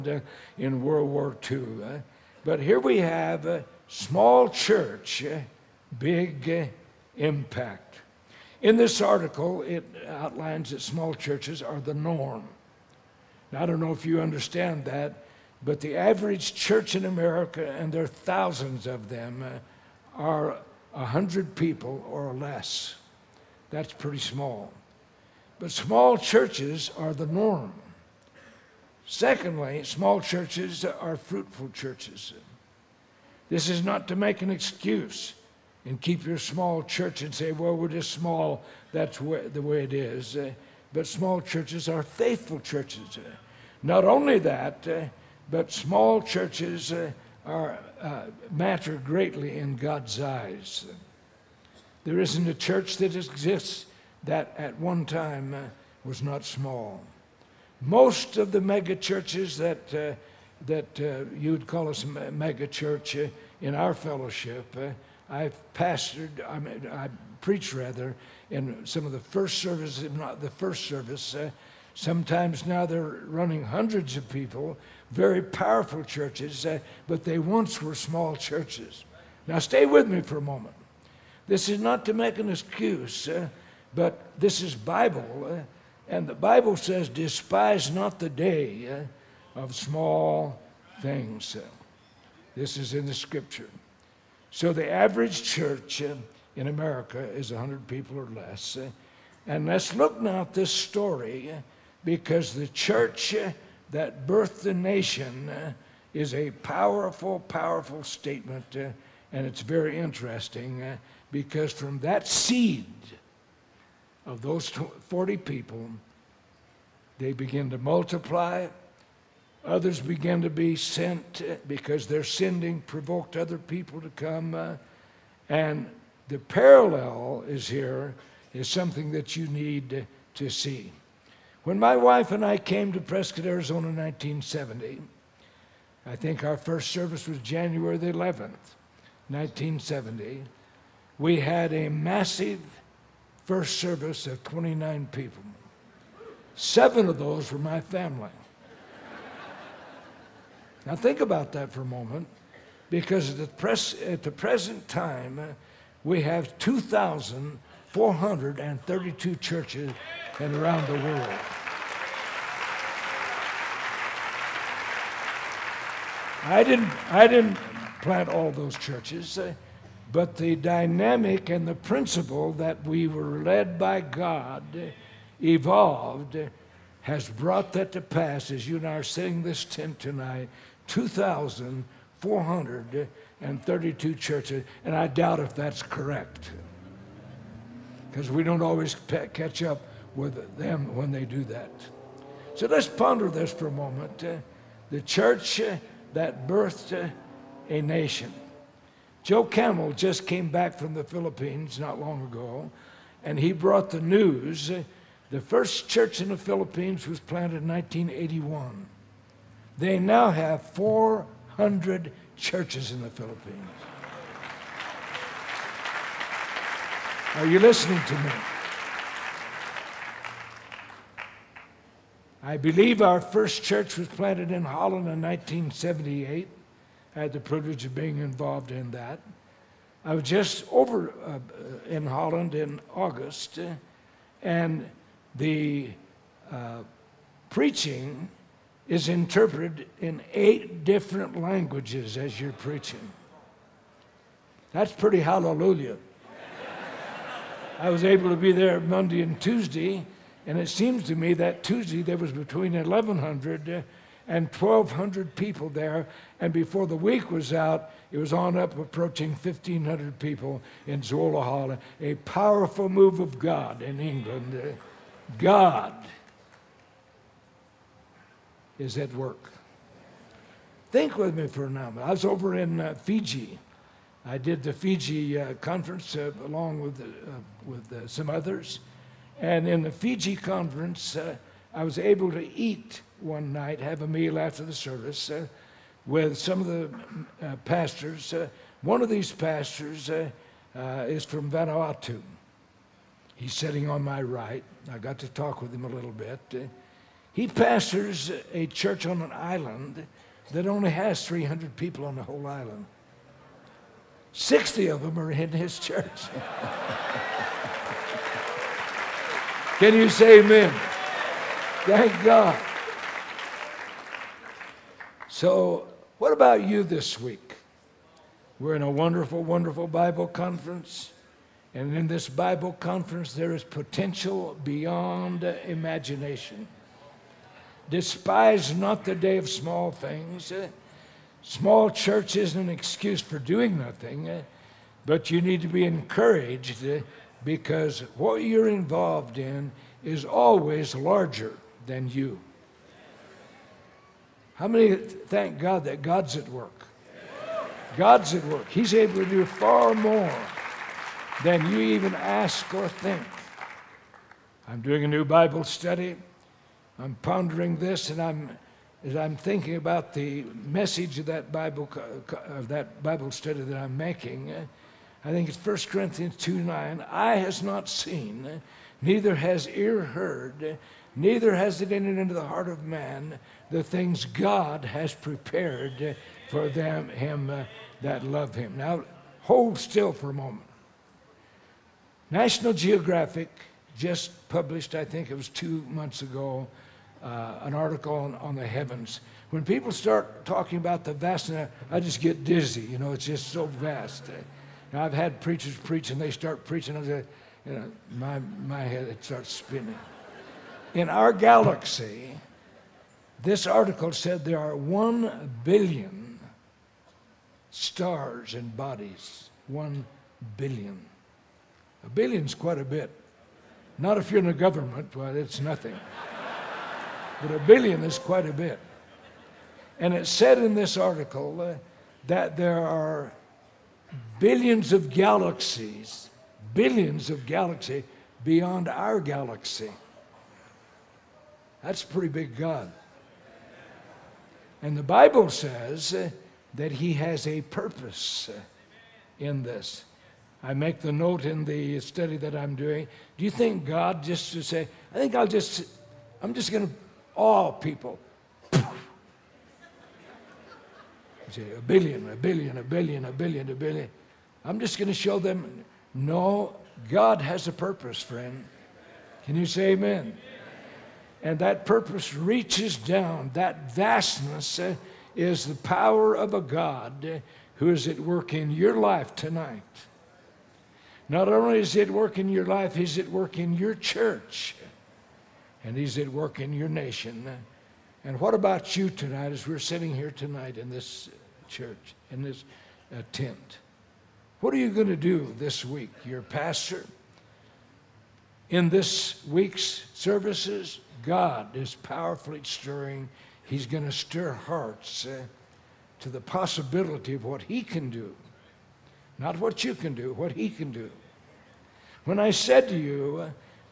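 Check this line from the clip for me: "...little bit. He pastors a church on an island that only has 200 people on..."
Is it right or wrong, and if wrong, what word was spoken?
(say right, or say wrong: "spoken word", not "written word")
wrong: "300", not "200".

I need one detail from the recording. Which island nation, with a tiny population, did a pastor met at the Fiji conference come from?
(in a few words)
Vanuatu.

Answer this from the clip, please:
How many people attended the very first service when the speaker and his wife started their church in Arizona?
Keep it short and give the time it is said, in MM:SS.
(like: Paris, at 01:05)
29, at 02:24.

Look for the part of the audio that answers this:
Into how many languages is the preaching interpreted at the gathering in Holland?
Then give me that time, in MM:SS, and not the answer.
04:00.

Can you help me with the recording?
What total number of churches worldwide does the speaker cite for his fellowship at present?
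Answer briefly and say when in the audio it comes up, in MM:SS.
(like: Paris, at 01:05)
2,432, at 03:00.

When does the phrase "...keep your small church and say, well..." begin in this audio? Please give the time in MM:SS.
00:36.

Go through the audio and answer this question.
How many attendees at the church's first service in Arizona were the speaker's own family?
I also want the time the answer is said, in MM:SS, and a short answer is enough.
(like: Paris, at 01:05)
7, at 02:26.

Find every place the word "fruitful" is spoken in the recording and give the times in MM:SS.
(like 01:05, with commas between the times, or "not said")
00:31.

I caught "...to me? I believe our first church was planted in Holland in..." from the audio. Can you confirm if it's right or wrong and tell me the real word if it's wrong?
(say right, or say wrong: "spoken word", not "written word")
right.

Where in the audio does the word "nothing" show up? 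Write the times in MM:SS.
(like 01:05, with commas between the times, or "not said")
05:33, 06:55.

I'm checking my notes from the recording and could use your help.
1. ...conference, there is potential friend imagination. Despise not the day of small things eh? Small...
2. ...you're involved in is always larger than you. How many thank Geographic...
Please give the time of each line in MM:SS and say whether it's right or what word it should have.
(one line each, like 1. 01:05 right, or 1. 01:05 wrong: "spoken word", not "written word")
1. 05:22 wrong: "beyond", not "friend"
2. 05:38 wrong: "God", not "Geographic".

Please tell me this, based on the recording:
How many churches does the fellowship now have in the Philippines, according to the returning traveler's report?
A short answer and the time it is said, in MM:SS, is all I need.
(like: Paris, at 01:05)
400, at 03:30.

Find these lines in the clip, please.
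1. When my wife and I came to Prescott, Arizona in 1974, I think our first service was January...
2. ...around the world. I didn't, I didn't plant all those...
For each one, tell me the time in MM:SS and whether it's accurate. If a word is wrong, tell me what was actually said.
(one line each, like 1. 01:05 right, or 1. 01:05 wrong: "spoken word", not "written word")
1. 02:11 wrong: "1970", not "1974"
2. 02:40 right.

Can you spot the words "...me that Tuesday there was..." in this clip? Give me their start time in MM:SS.
04:11.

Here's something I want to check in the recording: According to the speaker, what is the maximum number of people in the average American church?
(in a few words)
100.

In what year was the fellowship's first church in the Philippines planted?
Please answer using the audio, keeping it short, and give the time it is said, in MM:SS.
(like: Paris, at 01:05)
1981, at 03:27.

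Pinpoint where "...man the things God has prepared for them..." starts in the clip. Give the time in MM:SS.
06:12.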